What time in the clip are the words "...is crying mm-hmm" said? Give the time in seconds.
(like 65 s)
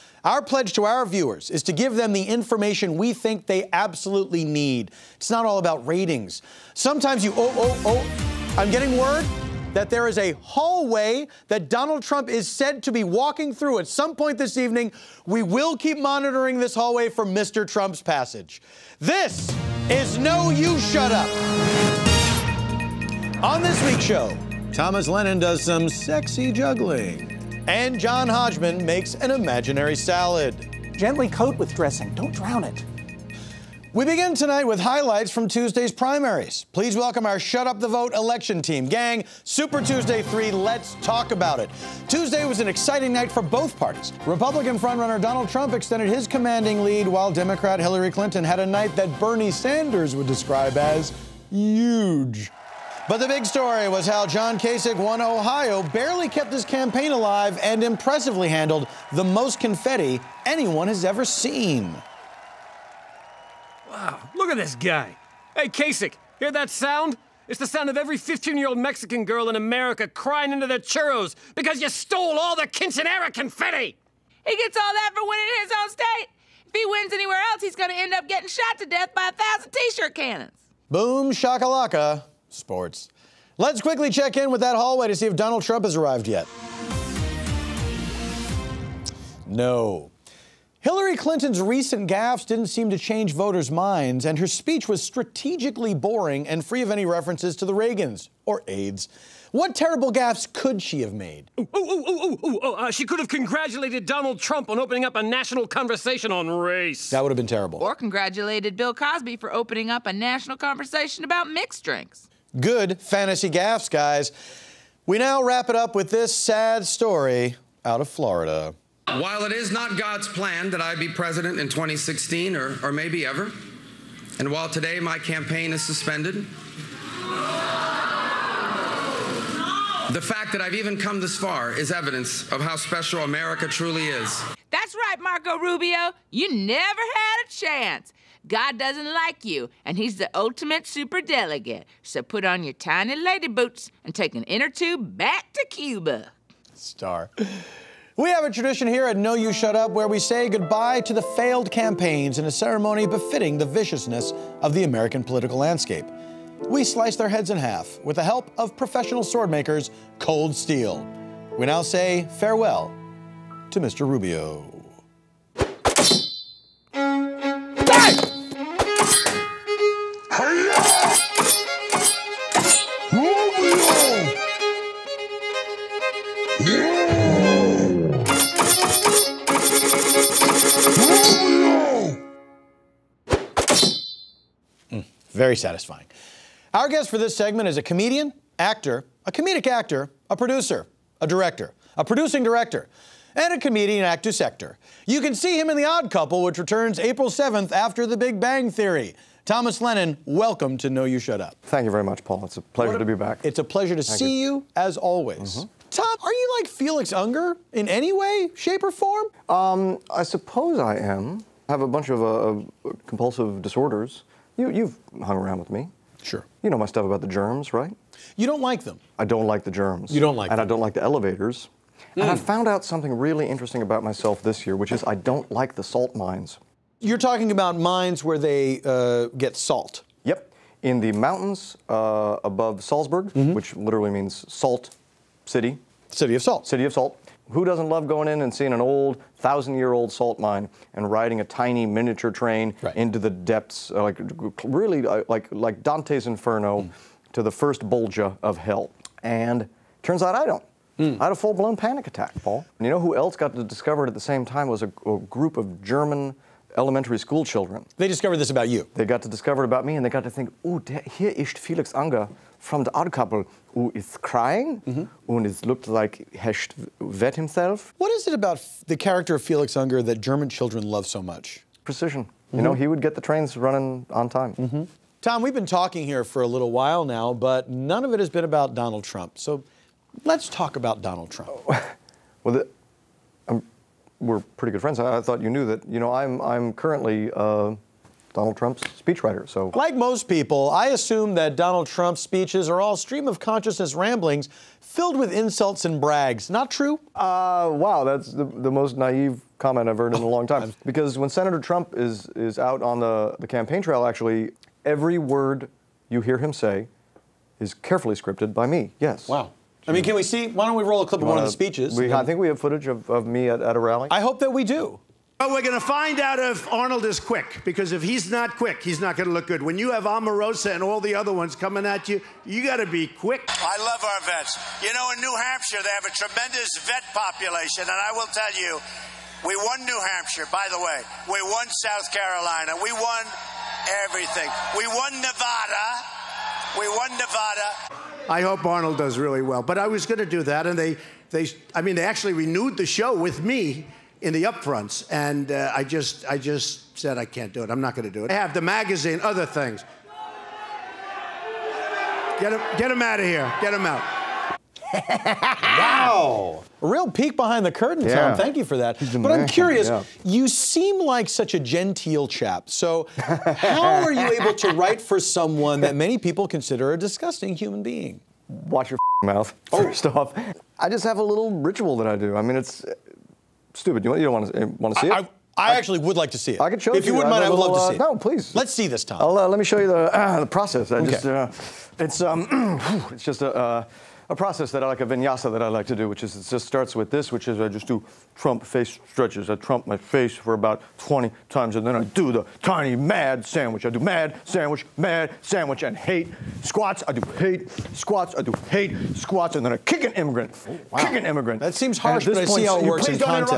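263 s.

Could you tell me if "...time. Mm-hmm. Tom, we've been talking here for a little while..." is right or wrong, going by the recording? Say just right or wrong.
right.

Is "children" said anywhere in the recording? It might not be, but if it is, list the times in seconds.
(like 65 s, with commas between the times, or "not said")
257 s, 270 s.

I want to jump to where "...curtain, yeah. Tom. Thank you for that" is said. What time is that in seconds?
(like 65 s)
357 s.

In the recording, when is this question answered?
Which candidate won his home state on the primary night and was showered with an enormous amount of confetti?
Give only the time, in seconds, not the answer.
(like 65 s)
54 s.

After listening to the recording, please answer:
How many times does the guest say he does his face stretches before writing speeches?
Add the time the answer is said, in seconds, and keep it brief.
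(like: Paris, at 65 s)
20, at 390 s.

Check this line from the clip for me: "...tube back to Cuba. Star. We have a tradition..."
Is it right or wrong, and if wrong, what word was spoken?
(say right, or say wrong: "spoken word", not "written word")
right.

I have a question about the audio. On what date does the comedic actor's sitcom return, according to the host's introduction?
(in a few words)
April 7th.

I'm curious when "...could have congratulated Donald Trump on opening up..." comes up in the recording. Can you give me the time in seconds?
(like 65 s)
103 s.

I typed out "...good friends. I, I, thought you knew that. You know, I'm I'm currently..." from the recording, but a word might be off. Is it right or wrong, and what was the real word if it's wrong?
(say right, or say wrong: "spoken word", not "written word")
right.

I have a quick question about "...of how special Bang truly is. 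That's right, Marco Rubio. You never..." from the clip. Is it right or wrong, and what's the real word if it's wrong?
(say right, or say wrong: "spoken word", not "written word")
wrong: "America", not "Bang".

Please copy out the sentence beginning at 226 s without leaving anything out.
You're talking about mines where they uh, get salt.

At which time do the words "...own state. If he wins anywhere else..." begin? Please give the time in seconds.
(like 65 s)
75 s.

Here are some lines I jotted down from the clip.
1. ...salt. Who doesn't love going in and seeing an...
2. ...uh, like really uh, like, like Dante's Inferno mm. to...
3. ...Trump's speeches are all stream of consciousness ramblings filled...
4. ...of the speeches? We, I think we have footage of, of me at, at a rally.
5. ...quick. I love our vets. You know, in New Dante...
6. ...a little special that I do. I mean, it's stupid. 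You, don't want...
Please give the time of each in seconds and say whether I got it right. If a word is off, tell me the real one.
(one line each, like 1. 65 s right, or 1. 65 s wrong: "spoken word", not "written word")
1. 236 s right
2. 243 s right
3. 291 s right
4. 311 s right
5. 323 s wrong: "Hampshire", not "Dante"
6. 371 s wrong: "ritual", not "special".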